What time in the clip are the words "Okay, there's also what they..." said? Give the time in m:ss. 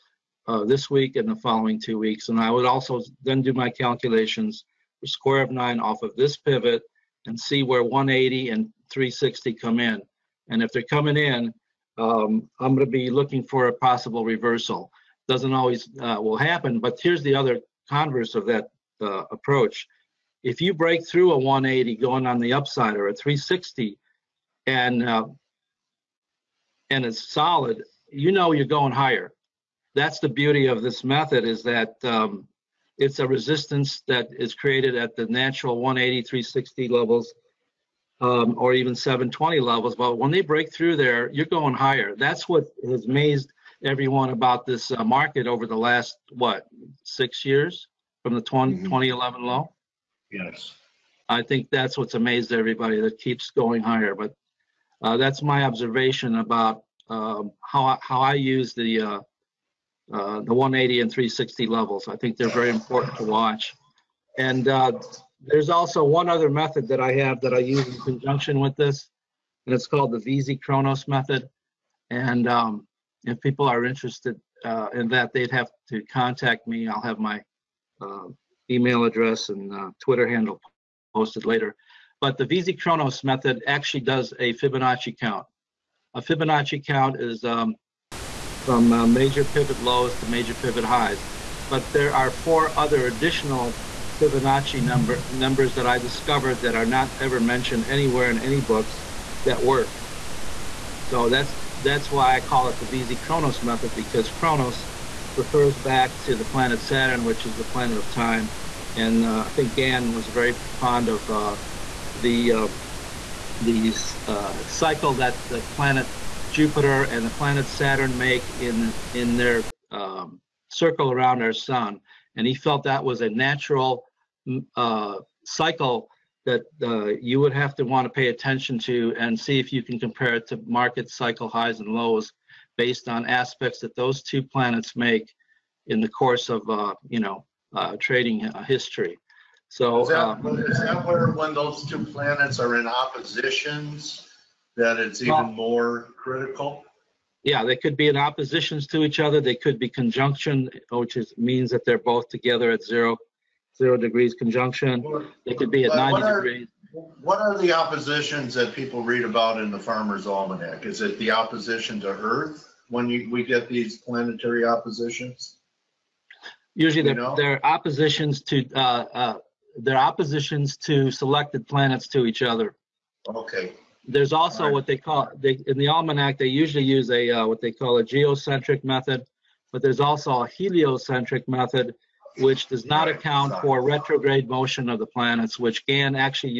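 2:53.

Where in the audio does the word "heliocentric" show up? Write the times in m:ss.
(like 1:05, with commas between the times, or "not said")
3:00.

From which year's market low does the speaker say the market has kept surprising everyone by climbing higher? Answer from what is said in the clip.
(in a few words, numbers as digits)
2011.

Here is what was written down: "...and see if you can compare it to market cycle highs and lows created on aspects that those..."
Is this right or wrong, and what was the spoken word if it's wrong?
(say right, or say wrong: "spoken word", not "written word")
wrong: "based", not "created".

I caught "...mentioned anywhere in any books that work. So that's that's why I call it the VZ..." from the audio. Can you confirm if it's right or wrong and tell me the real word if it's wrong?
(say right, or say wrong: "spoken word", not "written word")
right.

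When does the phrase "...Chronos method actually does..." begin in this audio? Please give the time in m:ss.
1:22.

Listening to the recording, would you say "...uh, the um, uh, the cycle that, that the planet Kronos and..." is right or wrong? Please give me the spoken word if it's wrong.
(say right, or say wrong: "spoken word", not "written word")
wrong: "Jupiter", not "Kronos".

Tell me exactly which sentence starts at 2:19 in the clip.
So is that, um, is that where when those two planets are in oppositions?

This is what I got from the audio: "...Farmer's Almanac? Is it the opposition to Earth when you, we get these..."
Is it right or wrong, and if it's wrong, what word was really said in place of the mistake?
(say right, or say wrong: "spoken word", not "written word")
right.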